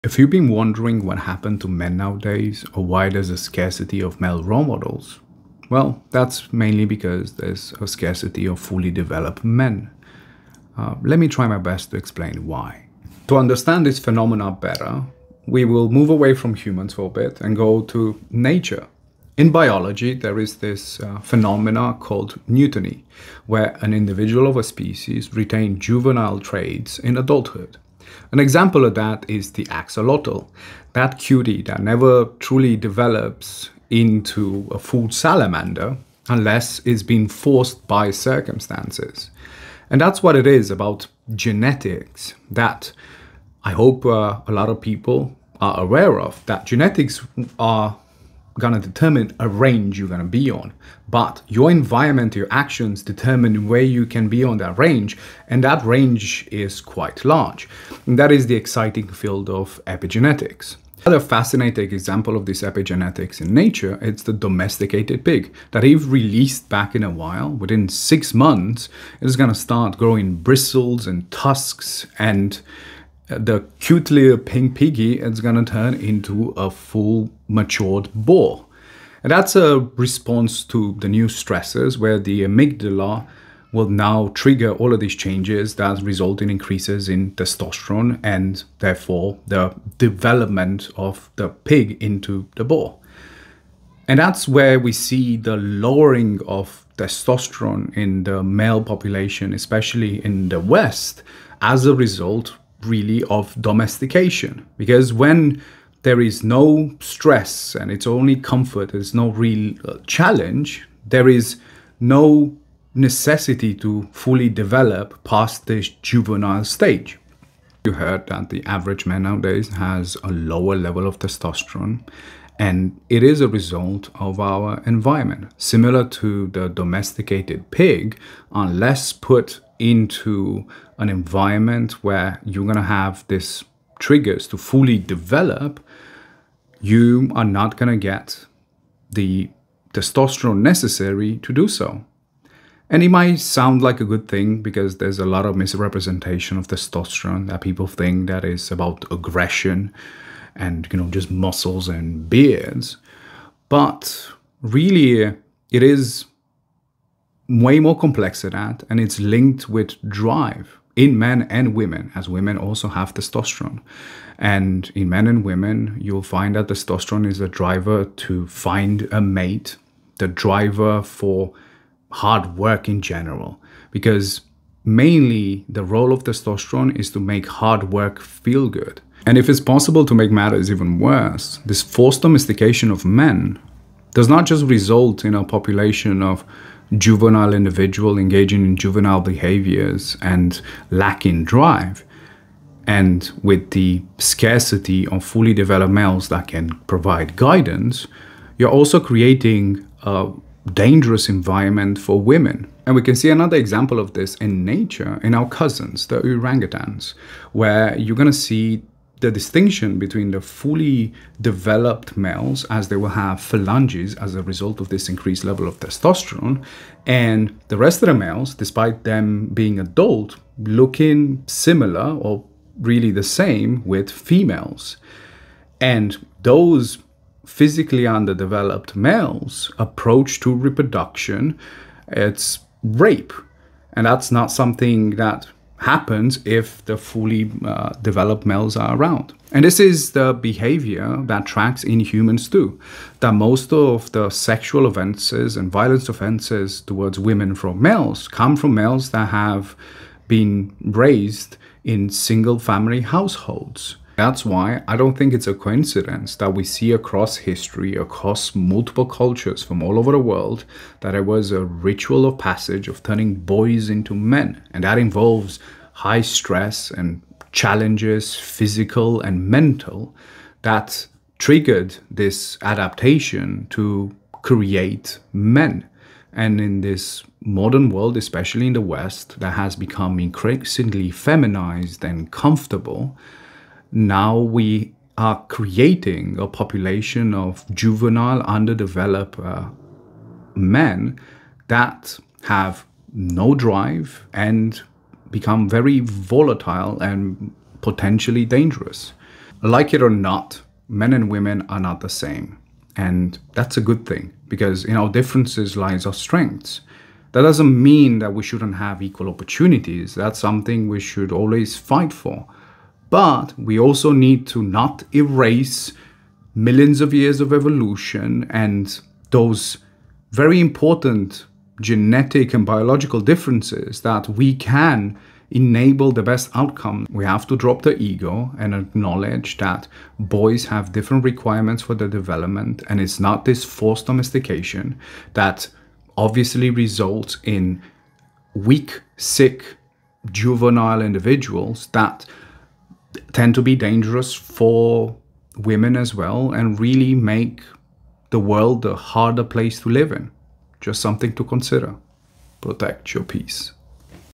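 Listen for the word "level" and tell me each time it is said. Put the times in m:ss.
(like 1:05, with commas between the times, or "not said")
2:00, 3:35.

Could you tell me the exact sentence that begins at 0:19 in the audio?
In biology, there is this uh, phenomena called neoteny, where an individual of a species retains juvenile traits in adulthood.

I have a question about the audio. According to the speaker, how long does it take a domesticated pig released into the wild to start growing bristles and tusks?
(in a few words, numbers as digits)
6 months.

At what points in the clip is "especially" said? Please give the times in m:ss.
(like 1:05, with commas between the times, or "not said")
1:39, 4:38.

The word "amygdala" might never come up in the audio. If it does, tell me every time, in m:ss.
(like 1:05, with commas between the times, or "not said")
1:22.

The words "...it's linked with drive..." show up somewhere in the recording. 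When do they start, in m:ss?
2:38.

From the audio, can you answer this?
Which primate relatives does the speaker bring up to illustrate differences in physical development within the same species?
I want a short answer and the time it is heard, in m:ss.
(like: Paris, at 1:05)
orangutans, at 3:26.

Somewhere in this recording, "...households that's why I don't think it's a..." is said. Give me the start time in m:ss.
4:13.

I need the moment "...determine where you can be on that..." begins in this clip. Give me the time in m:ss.
0:53.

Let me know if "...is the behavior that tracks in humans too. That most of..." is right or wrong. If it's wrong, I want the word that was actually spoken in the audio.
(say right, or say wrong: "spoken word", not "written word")
right.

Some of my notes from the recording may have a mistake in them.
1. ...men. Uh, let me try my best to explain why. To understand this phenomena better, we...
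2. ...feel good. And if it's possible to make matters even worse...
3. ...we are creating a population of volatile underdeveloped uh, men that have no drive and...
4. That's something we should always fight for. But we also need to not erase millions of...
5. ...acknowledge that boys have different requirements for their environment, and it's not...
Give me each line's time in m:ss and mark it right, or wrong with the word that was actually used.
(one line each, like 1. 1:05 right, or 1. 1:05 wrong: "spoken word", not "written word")
1. 0:09 right
2. 2:58 right
3. 4:44 wrong: "juvenile", not "volatile"
4. 5:10 right
5. 5:28 wrong: "development", not "environment".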